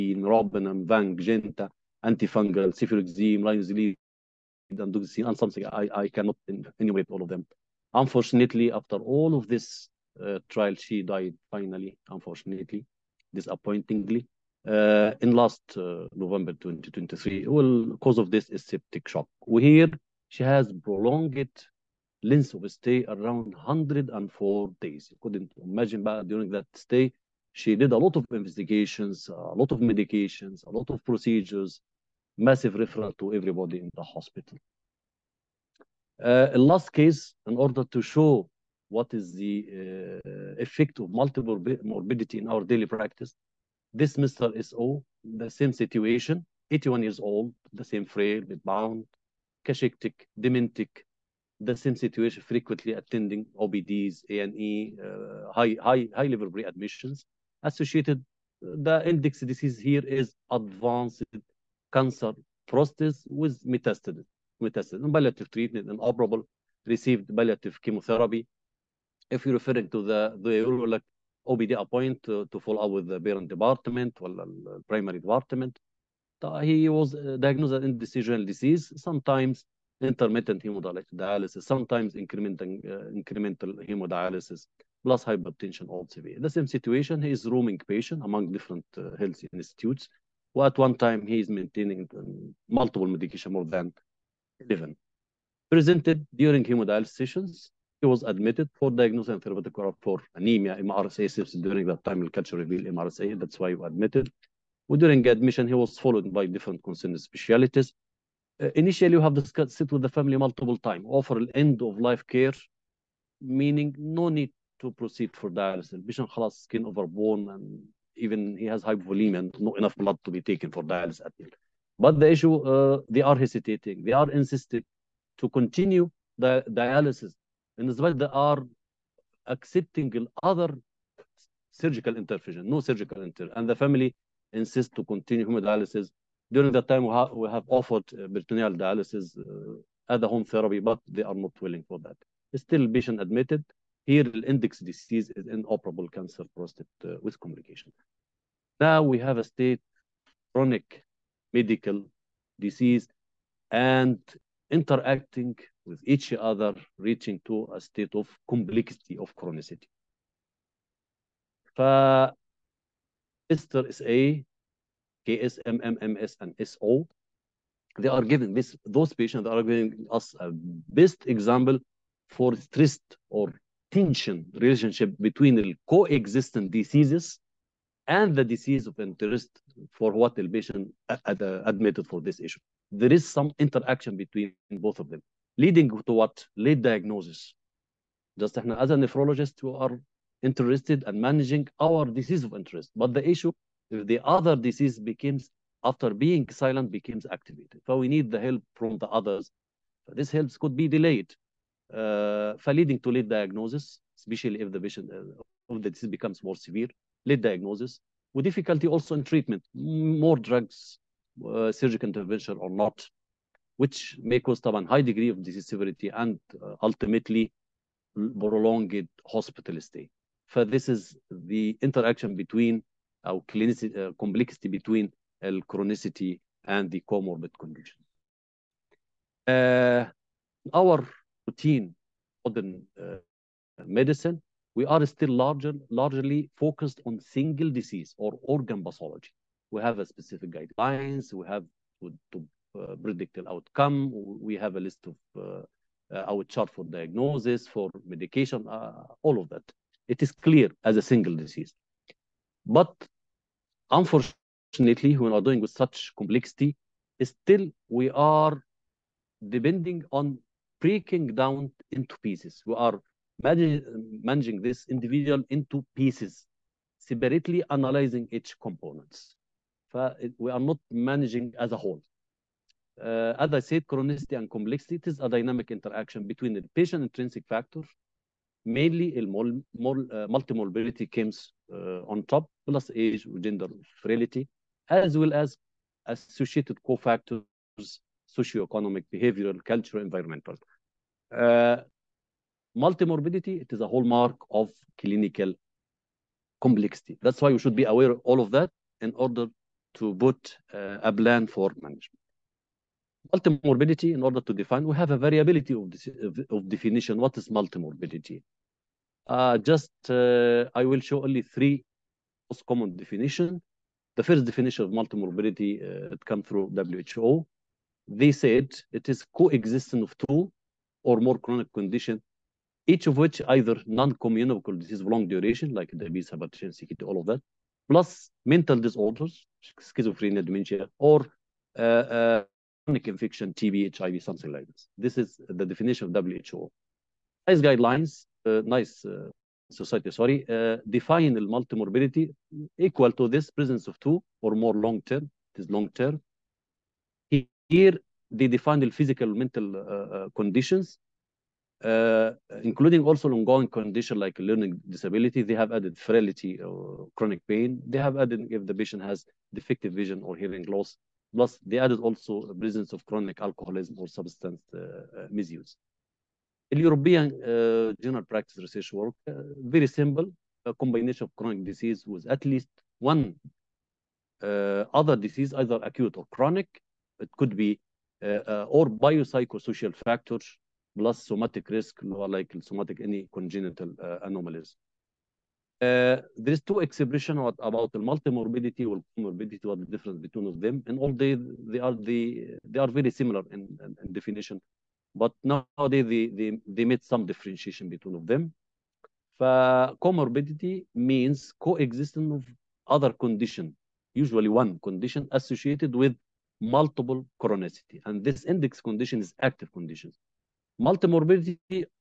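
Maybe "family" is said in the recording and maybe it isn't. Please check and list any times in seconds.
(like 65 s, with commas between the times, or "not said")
110 s, 133 s.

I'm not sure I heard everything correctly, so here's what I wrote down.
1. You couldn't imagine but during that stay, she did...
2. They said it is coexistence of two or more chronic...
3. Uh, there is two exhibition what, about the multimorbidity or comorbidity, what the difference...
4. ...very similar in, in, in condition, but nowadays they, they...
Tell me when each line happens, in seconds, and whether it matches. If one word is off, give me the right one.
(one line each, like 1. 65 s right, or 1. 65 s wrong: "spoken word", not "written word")
1. 25 s right
2. 318 s right
3. 385 s right
4. 392 s wrong: "definition", not "condition".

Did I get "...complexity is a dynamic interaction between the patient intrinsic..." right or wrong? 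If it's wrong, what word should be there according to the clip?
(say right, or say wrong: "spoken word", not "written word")
right.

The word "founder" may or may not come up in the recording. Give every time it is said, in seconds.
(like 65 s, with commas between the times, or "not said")
not said.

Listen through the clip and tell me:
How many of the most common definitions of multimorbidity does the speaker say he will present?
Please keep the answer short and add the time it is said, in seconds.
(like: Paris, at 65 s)
3, at 311 s.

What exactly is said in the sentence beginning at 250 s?
It is clear as a single disease.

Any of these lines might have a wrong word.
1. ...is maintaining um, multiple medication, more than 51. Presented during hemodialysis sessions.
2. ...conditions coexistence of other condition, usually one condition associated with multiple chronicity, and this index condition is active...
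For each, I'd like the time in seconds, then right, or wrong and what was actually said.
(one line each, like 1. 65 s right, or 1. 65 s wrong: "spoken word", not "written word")
1. 91 s wrong: "11", not "51"
2. 401 s wrong: "means", not "conditions".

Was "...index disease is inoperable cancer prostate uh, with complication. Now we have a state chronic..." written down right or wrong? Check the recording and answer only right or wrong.
right.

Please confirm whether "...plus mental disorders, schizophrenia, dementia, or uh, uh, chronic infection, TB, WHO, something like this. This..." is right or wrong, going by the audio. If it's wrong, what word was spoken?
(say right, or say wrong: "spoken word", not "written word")
wrong: "HIV", not "WHO".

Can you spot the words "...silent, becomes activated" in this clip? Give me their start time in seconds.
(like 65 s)
196 s.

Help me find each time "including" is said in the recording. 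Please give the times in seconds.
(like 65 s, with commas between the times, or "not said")
352 s.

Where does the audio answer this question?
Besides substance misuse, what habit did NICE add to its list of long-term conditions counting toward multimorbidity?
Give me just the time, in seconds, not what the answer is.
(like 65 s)
363 s.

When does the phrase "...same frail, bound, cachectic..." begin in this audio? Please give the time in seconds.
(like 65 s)
47 s.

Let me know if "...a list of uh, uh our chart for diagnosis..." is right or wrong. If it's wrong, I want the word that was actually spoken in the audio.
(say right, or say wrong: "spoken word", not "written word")
right.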